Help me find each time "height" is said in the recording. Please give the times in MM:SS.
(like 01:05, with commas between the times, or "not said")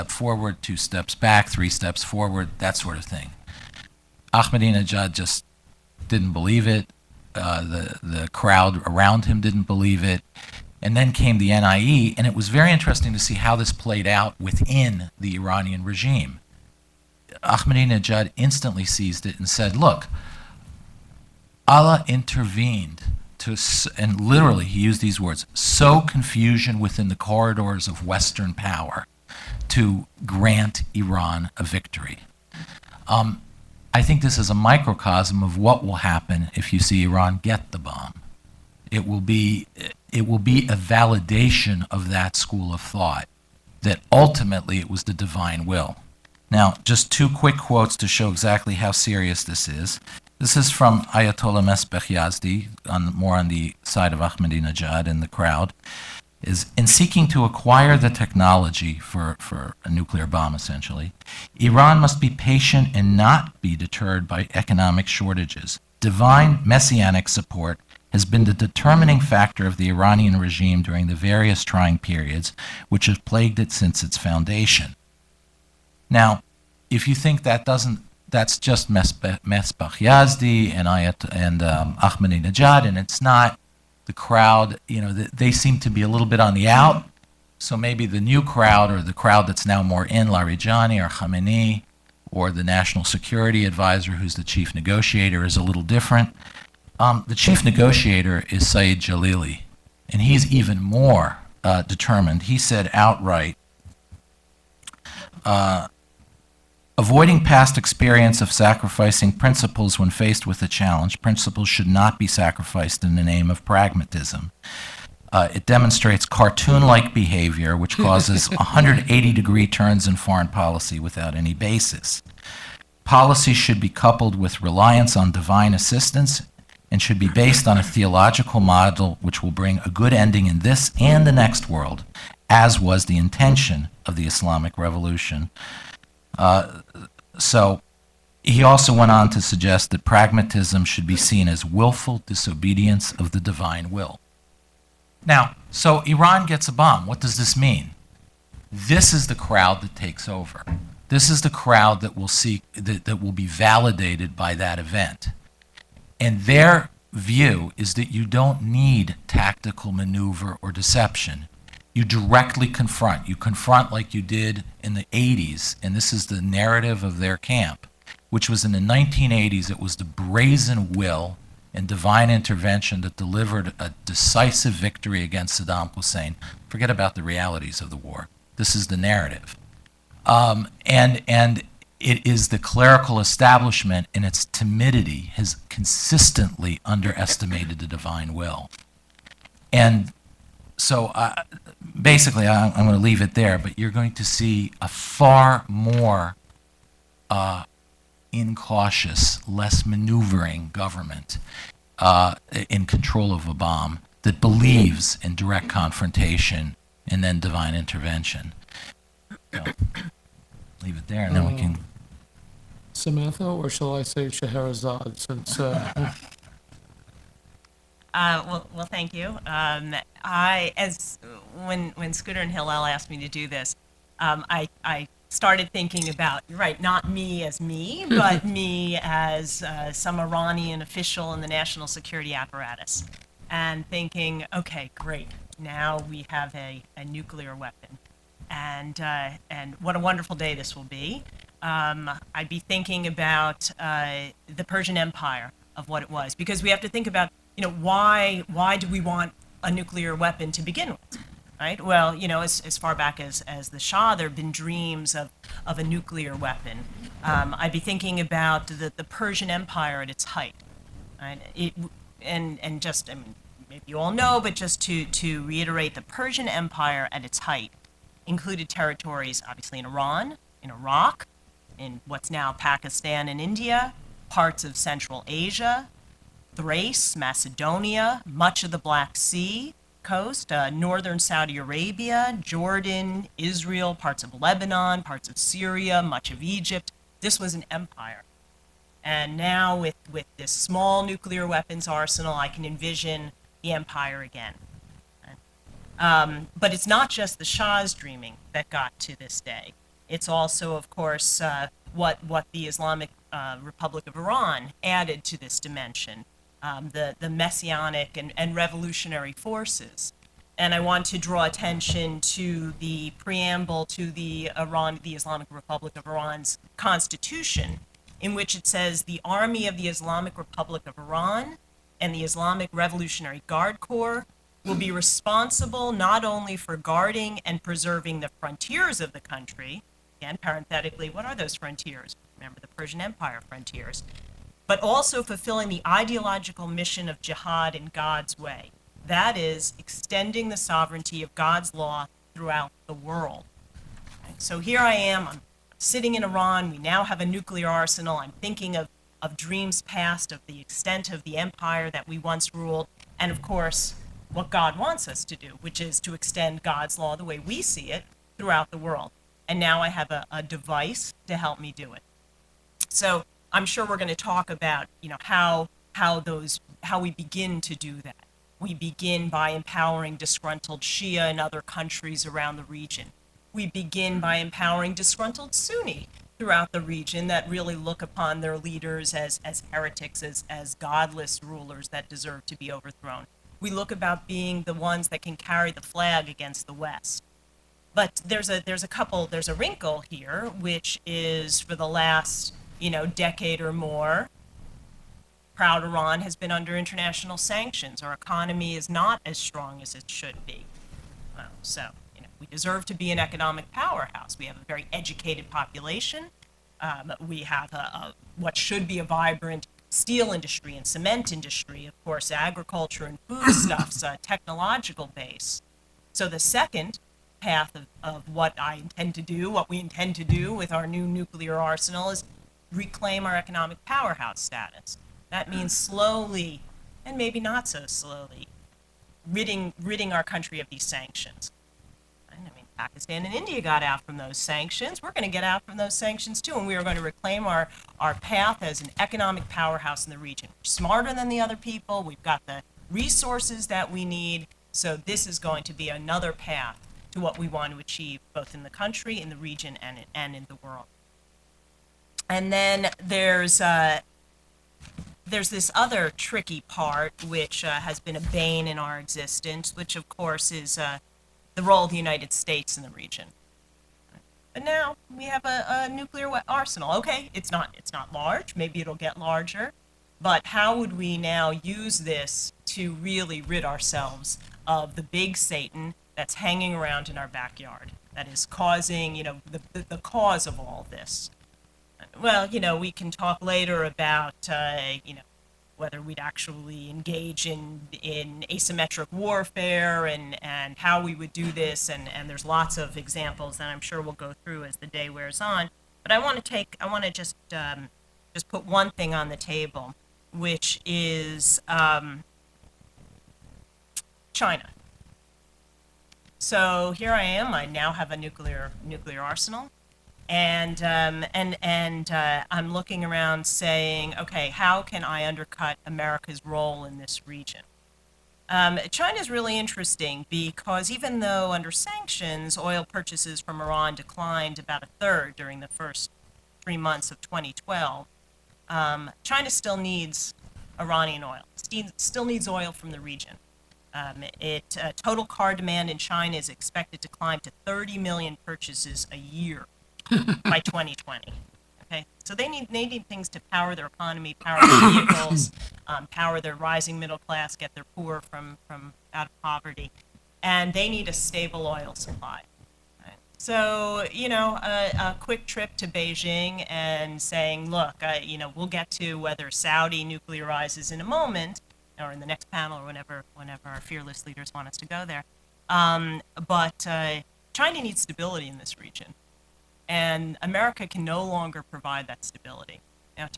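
04:20, 04:27.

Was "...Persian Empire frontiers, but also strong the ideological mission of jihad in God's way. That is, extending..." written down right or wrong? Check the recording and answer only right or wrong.
wrong.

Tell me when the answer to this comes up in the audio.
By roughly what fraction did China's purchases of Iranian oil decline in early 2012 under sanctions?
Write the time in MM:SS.
08:44.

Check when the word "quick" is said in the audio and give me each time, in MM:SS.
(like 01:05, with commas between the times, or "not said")
00:47, 09:15.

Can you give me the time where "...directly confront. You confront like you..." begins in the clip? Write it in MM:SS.
02:42.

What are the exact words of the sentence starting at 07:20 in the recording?
We're smarter than the other people.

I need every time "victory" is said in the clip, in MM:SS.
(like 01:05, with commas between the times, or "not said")
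00:31, 02:54.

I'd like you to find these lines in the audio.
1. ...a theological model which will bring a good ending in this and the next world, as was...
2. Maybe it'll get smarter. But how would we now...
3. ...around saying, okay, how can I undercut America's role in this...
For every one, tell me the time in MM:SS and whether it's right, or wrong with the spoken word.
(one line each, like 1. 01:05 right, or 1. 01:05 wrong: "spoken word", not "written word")
1. 02:07 right
2. 07:48 wrong: "larger", not "smarter"
3. 08:33 right.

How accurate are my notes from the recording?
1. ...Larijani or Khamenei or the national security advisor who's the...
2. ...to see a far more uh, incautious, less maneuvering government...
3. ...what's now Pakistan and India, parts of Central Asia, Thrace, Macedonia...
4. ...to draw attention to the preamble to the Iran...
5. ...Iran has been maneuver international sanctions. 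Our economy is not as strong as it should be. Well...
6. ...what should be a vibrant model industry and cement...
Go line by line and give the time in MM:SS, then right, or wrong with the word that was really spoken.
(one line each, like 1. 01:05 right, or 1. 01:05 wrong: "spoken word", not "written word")
1. 01:30 right
2. 03:14 right
3. 04:32 right
4. 05:11 right
5. 06:35 wrong: "under", not "maneuver"
6. 06:48 wrong: "steel", not "model".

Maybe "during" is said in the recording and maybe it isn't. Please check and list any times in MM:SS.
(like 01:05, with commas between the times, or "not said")
01:10, 08:45.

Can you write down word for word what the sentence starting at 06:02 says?
So I'm sure we're going to talk about, you know, how how those how we begin to do that.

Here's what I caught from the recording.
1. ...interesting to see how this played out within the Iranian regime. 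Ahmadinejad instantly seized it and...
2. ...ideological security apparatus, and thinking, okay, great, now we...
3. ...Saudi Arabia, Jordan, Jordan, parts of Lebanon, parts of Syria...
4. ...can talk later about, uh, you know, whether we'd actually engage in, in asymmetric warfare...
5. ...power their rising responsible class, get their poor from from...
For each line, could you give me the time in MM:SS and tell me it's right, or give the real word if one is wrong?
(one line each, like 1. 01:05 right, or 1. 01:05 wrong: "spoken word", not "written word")
1. 00:12 right
2. 03:51 wrong: "national", not "ideological"
3. 04:41 wrong: "Israel", not "Jordan"
4. 08:02 right
5. 09:06 wrong: "middle", not "responsible".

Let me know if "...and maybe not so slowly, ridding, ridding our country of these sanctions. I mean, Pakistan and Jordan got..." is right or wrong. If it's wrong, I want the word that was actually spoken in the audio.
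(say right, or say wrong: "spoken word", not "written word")
wrong: "India", not "Jordan".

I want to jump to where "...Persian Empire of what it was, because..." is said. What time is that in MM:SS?
04:04.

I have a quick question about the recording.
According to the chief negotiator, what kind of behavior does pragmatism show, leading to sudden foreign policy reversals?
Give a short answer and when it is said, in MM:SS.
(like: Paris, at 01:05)
cartoon like behavior, at 01:56.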